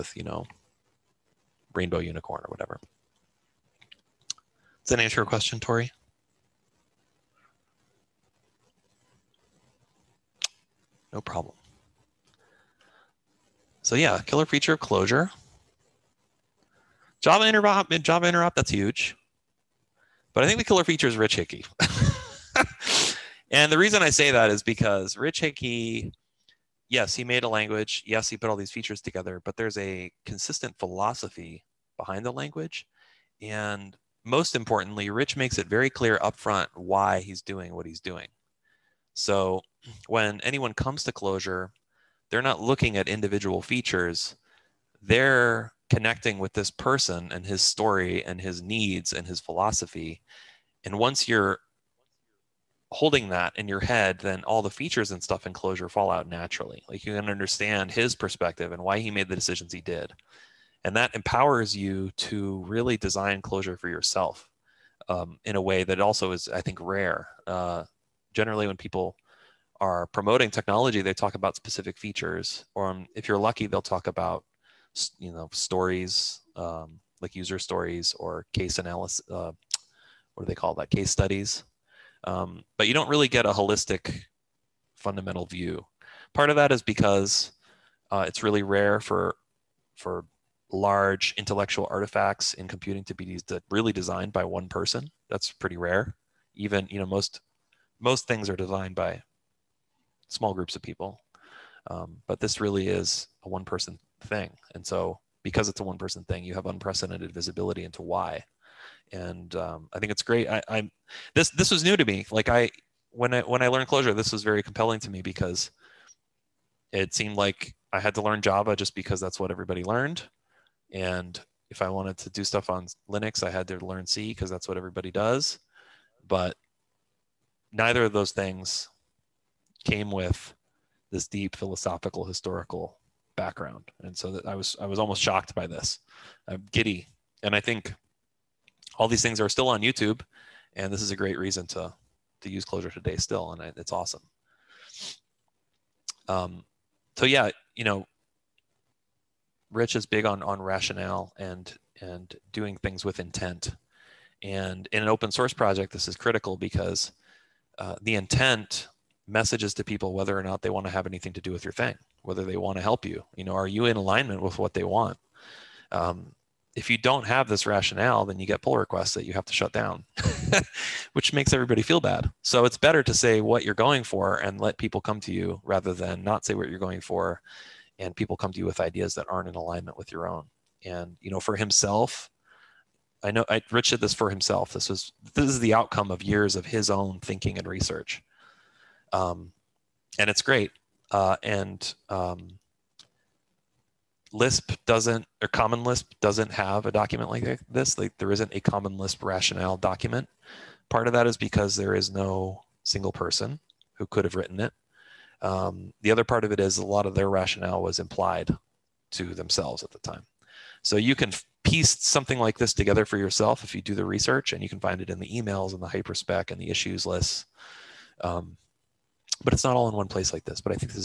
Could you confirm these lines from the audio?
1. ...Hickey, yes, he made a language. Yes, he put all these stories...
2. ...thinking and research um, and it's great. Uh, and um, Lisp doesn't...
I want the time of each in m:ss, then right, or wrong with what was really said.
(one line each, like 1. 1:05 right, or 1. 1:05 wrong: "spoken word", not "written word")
1. 0:25 wrong: "features", not "stories"
2. 3:07 right.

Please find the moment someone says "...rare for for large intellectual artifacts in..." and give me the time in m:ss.
1:28.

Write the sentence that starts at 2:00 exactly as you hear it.
And if I wanted to do stuff on Linux, I had to learn C because that's what everybody does.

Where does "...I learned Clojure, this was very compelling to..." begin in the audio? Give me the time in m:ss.
1:53.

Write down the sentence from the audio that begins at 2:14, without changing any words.
And so that I was I was almost shocked by this.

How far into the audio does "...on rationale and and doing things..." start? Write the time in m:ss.
2:30.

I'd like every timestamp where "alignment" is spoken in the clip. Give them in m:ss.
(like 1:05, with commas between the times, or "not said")
2:43, 2:59.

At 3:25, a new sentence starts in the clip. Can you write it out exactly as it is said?
Um, the other part of it is a lot of their rationale was implied to themselves at the time.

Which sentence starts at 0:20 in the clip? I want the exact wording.
But I think the killer feature is Rich Hickey.